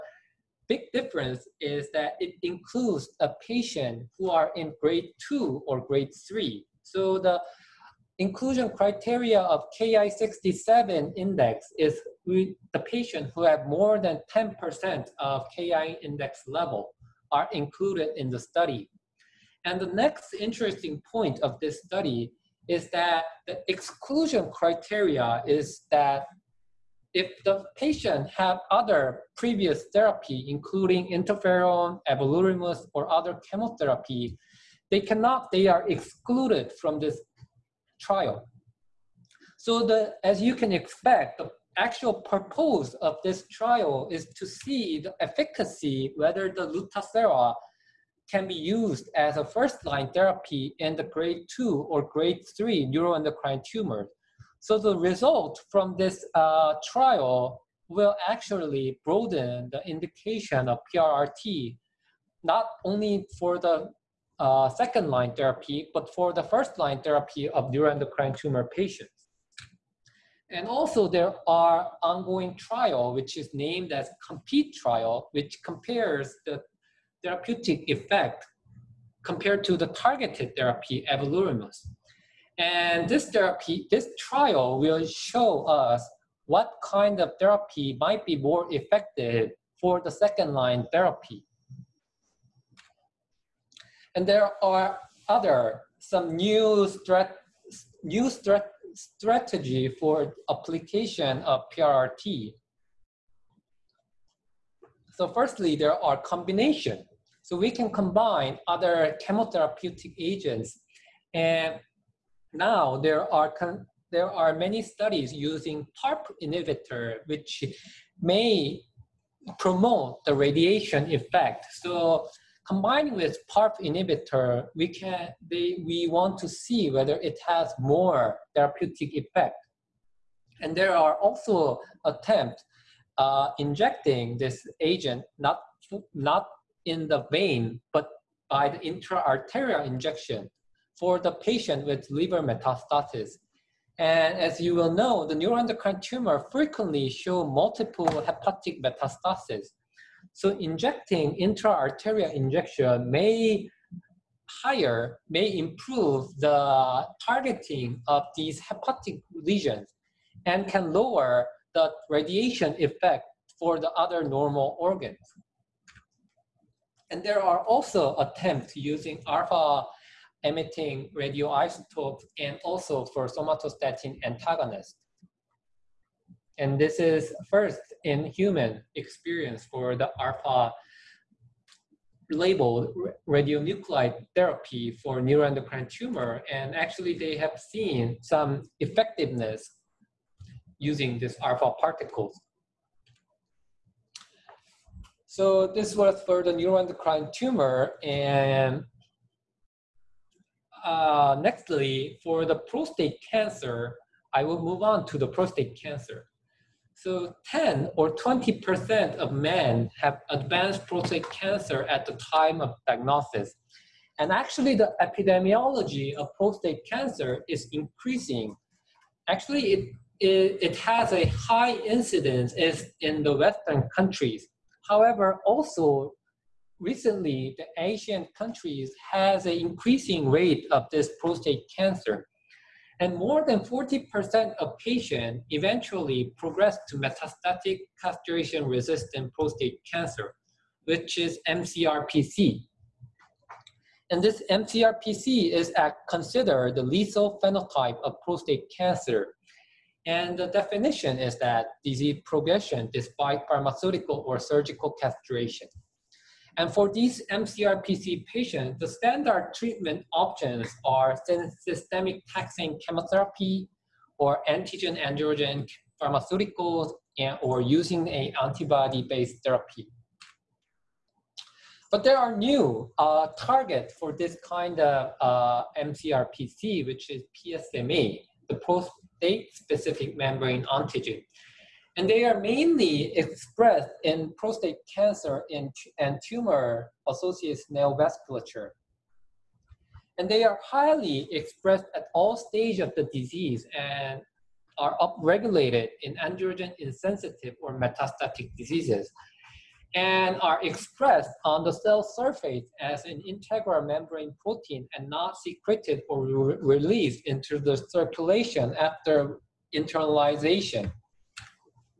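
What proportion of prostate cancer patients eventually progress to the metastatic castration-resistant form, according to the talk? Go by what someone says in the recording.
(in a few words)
more than 40%.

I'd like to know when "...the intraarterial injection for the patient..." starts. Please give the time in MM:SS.
02:18.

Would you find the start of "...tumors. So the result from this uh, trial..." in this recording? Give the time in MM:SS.
00:53.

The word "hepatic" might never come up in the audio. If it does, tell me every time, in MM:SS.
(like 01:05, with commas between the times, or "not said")
02:28, 02:38.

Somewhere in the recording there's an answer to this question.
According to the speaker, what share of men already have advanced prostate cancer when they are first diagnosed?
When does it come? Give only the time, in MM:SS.
03:27.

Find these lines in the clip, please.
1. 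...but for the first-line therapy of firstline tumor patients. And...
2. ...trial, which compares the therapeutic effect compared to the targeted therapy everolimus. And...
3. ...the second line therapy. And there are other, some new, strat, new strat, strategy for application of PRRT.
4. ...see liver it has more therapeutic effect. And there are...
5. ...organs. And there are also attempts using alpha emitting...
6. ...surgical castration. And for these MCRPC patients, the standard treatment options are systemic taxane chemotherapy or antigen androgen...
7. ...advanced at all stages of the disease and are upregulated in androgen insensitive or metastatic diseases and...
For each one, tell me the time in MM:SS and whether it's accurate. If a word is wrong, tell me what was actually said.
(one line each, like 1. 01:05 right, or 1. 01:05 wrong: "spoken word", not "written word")
1. 01:05 wrong: "neuroendocrine", not "firstline"
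2. 01:14 right
3. 01:30 right
4. 02:06 wrong: "whether", not "liver"
5. 02:44 right
6. 04:14 right
7. 04:51 wrong: "expressed", not "advanced".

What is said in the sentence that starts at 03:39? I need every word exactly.
Actually, it, it, it has a high incidence is in the Western countries.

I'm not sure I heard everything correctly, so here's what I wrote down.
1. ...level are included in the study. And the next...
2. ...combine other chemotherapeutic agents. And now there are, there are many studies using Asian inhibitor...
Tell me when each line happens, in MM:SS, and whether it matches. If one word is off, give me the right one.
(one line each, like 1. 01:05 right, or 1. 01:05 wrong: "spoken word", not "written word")
1. 00:16 right
2. 01:47 wrong: "PARP", not "Asian".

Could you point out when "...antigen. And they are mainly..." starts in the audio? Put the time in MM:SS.
04:40.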